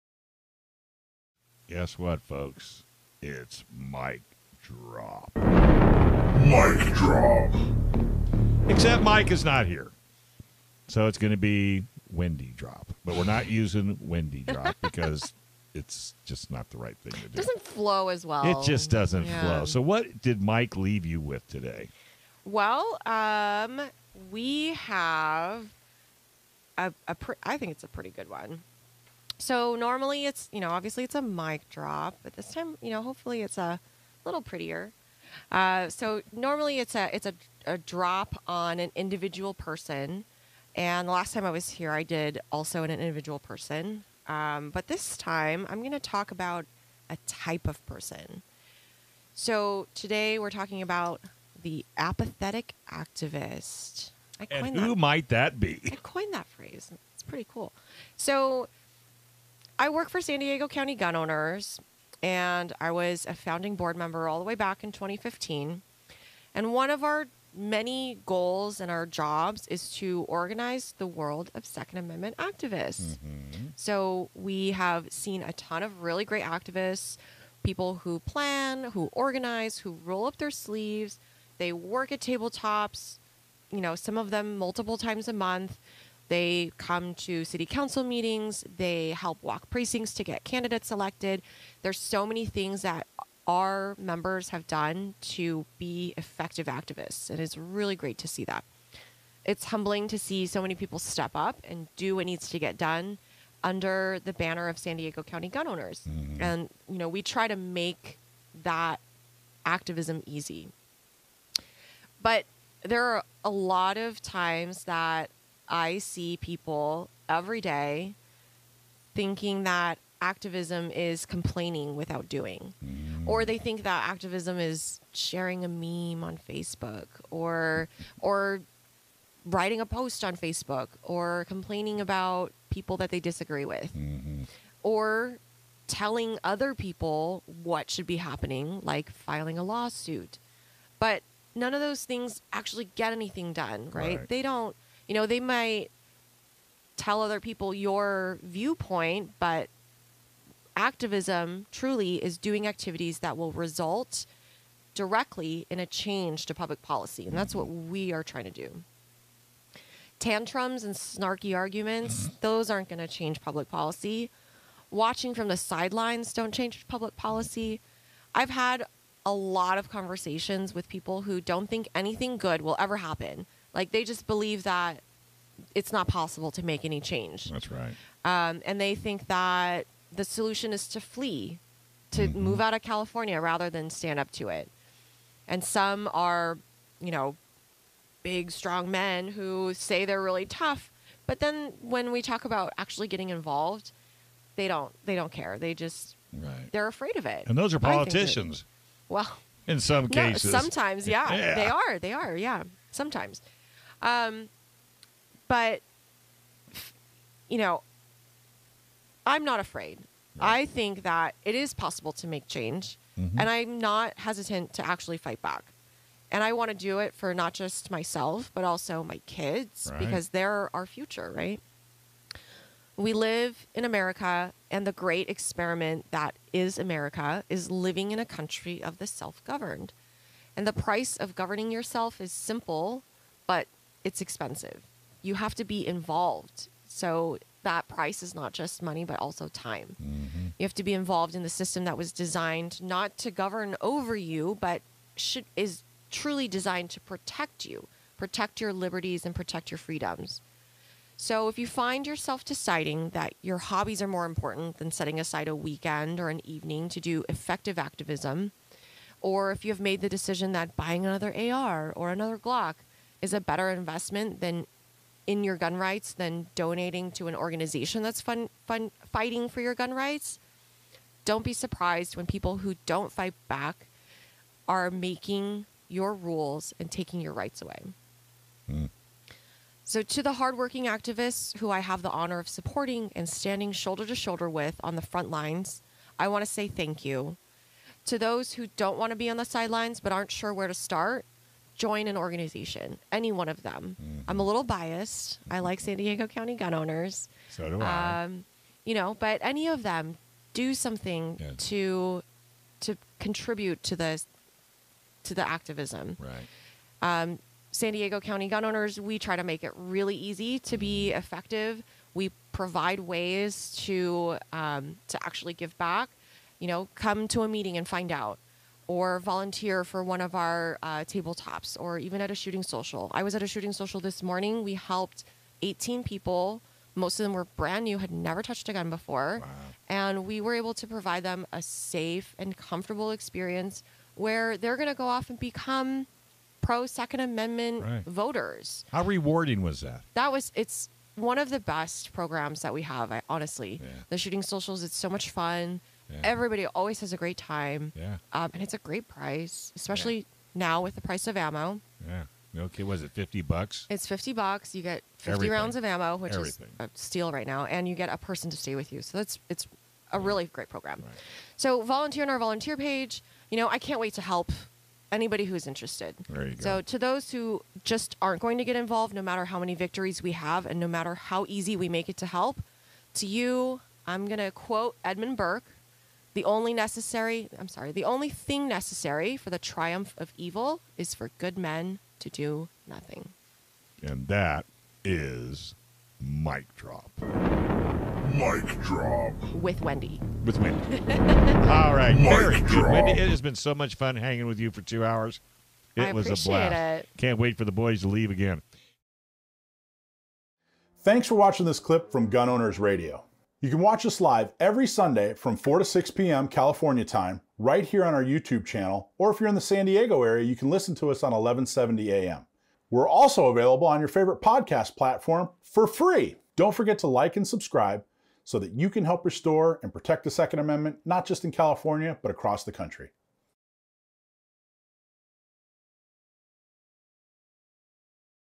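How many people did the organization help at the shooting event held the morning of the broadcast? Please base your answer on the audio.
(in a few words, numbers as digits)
18.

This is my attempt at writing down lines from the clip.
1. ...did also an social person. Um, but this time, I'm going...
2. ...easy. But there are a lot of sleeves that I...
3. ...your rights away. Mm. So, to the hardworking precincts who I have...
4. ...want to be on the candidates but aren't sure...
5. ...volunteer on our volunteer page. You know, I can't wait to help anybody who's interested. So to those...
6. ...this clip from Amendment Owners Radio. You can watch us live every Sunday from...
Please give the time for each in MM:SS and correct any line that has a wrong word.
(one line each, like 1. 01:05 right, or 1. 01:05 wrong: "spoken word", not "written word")
1. 00:42 wrong: "individual", not "social"
2. 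01:50 wrong: "times", not "sleeves"
3. 04:37 wrong: "activists", not "precincts"
4. 04:48 wrong: "sidelines", not "candidates"
5. 06:01 right
6. 06:41 wrong: "Gun", not "Amendment".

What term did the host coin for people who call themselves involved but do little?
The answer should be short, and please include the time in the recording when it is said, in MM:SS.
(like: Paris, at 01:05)
apathetic activist, at 00:51.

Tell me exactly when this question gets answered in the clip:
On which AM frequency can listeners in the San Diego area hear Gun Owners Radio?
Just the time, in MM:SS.
06:51.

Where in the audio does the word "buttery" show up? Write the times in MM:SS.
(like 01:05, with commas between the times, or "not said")
not said.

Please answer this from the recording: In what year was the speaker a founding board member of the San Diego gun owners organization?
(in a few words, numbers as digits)
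2015.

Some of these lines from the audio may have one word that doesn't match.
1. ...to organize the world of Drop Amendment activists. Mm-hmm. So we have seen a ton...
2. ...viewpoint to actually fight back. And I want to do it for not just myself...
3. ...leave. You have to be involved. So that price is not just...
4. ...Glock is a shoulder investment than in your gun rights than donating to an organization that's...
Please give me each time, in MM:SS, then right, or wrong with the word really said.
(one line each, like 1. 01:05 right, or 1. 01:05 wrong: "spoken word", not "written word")
1. 01:09 wrong: "Second", not "Drop"
2. 03:34 wrong: "hesitant", not "viewpoint"
3. 03:54 wrong: "expensive", not "leave"
4. 04:22 wrong: "better", not "shoulder".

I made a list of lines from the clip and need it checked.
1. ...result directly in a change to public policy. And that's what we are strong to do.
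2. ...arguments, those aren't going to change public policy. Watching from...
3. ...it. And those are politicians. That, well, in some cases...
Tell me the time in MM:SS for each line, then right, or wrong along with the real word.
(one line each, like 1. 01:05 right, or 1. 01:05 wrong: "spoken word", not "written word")
1. 02:33 wrong: "trying", not "strong"
2. 02:41 right
3. 03:17 right.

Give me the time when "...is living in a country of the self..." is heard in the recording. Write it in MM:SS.
03:47.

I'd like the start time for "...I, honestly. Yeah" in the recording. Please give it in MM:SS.
05:43.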